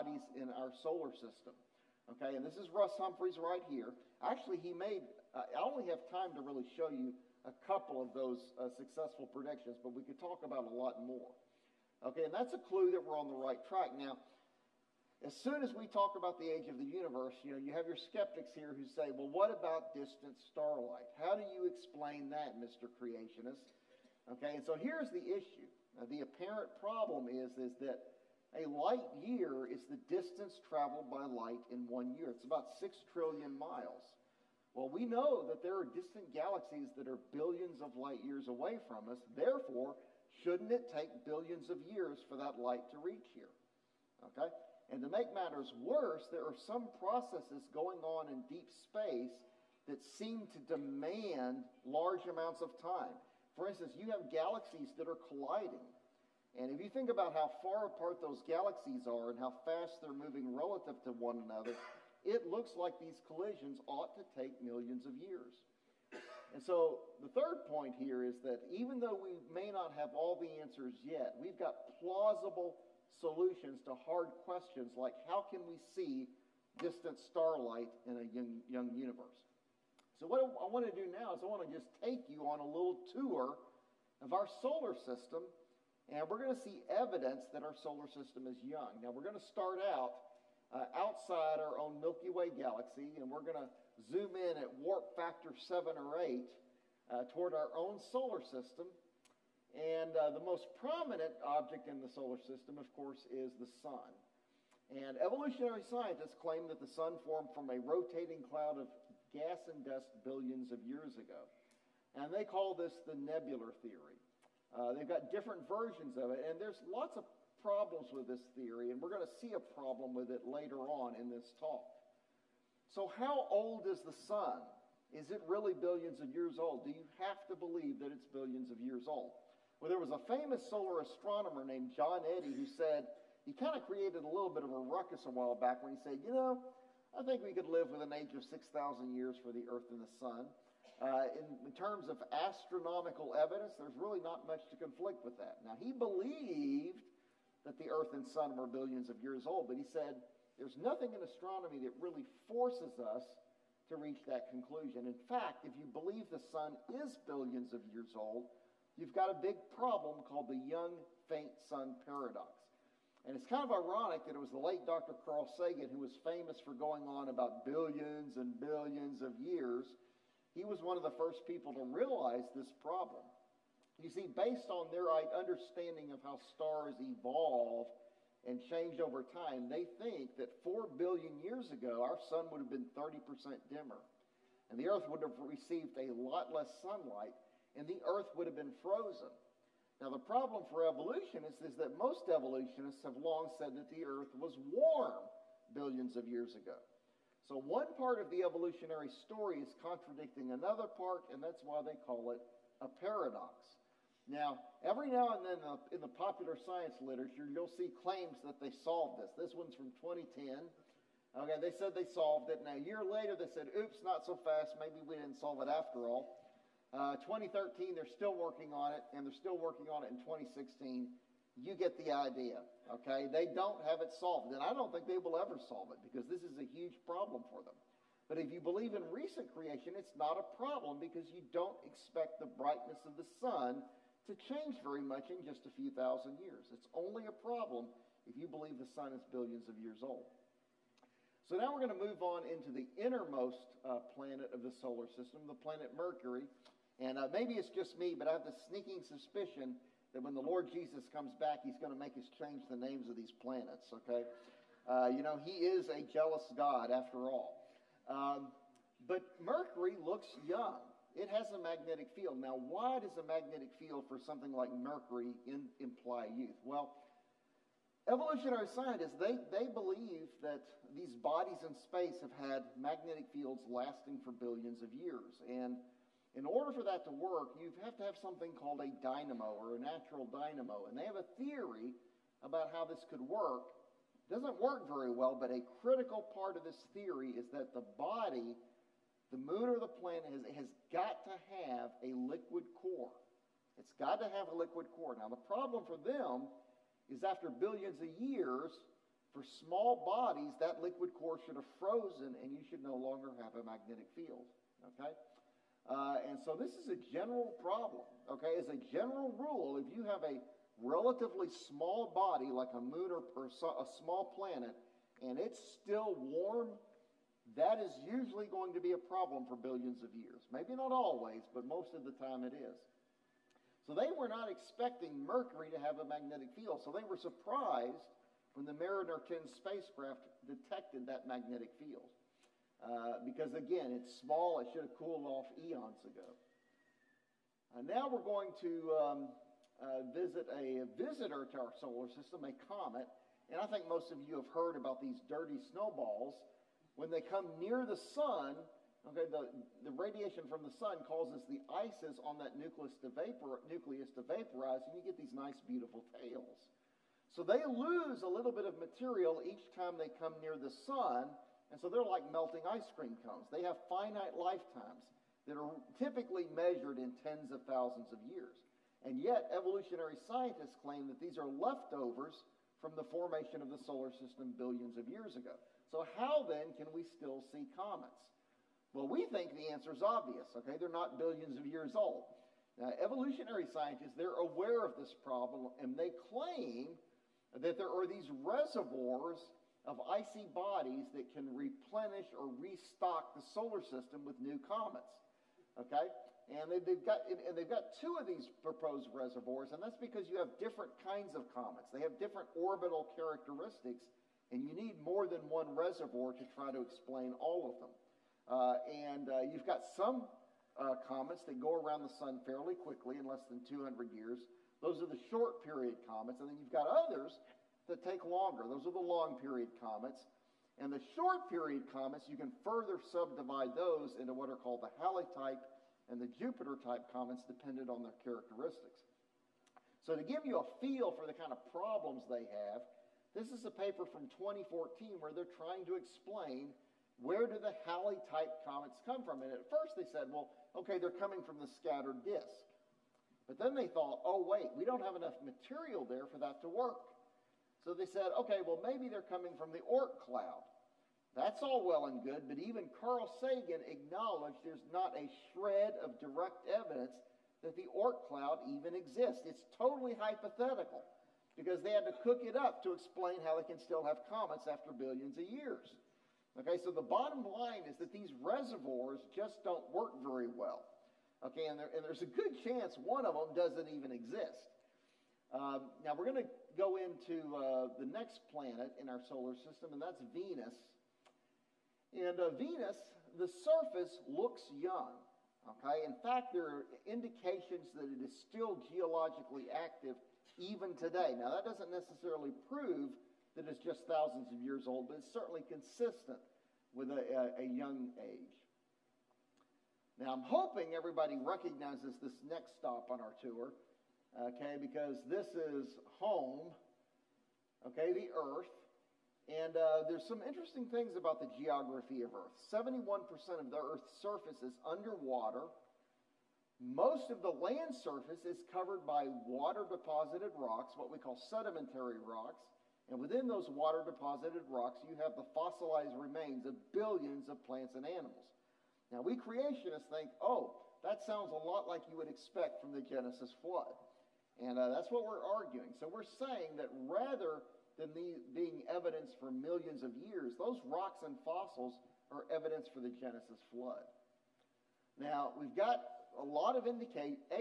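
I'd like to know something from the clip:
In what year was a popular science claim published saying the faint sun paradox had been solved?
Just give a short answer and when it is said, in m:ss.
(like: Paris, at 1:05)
2010, at 3:30.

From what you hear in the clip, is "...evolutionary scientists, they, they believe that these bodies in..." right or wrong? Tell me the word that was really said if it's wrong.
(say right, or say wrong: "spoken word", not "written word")
right.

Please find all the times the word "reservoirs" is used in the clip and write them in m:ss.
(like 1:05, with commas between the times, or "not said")
6:28, 6:39, 6:45, 7:48.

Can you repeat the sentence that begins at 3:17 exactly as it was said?
So, one part of the evolutionary story is contradicting another part, and that's why they call it a paradox.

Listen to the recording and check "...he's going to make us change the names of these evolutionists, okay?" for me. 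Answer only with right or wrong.
wrong.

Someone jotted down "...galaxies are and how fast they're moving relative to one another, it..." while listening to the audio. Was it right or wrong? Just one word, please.
right.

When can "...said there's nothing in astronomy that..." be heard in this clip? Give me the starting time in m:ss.
2:29.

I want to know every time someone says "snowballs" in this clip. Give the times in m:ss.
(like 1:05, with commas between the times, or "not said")
5:45.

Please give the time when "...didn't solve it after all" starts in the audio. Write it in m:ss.
3:35.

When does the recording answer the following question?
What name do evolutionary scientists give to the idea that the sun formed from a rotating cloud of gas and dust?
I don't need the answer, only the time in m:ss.
1:53.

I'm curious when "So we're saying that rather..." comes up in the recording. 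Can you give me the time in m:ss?
8:56.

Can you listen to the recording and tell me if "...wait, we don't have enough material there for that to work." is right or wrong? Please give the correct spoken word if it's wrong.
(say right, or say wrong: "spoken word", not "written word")
right.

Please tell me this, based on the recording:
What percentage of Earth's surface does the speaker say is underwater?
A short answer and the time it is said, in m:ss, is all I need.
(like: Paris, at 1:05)
71%, at 8:32.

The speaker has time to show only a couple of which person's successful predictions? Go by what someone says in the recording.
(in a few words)
Russ Humphreys.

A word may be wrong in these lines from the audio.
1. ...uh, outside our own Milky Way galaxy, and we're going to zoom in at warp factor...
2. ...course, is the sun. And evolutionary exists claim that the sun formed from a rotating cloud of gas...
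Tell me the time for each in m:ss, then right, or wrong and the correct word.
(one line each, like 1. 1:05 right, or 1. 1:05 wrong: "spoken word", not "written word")
1. 1:30 right
2. 1:42 wrong: "scientists", not "exists".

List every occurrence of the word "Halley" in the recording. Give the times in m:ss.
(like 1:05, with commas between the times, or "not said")
7:05, 7:17.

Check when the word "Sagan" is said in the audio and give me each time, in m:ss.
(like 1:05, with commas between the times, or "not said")
2:45, 7:33.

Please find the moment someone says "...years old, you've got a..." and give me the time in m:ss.
2:37.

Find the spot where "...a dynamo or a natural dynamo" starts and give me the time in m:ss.
4:38.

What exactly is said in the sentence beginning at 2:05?
Is it really billions of years old?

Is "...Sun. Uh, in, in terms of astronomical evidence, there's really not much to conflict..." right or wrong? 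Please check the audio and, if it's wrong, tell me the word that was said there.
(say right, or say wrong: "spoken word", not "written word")
right.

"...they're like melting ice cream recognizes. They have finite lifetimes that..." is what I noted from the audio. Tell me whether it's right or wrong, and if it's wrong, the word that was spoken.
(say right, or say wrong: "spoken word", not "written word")
wrong: "cones", not "recognizes".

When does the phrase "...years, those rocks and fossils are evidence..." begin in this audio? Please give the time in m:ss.
9:00.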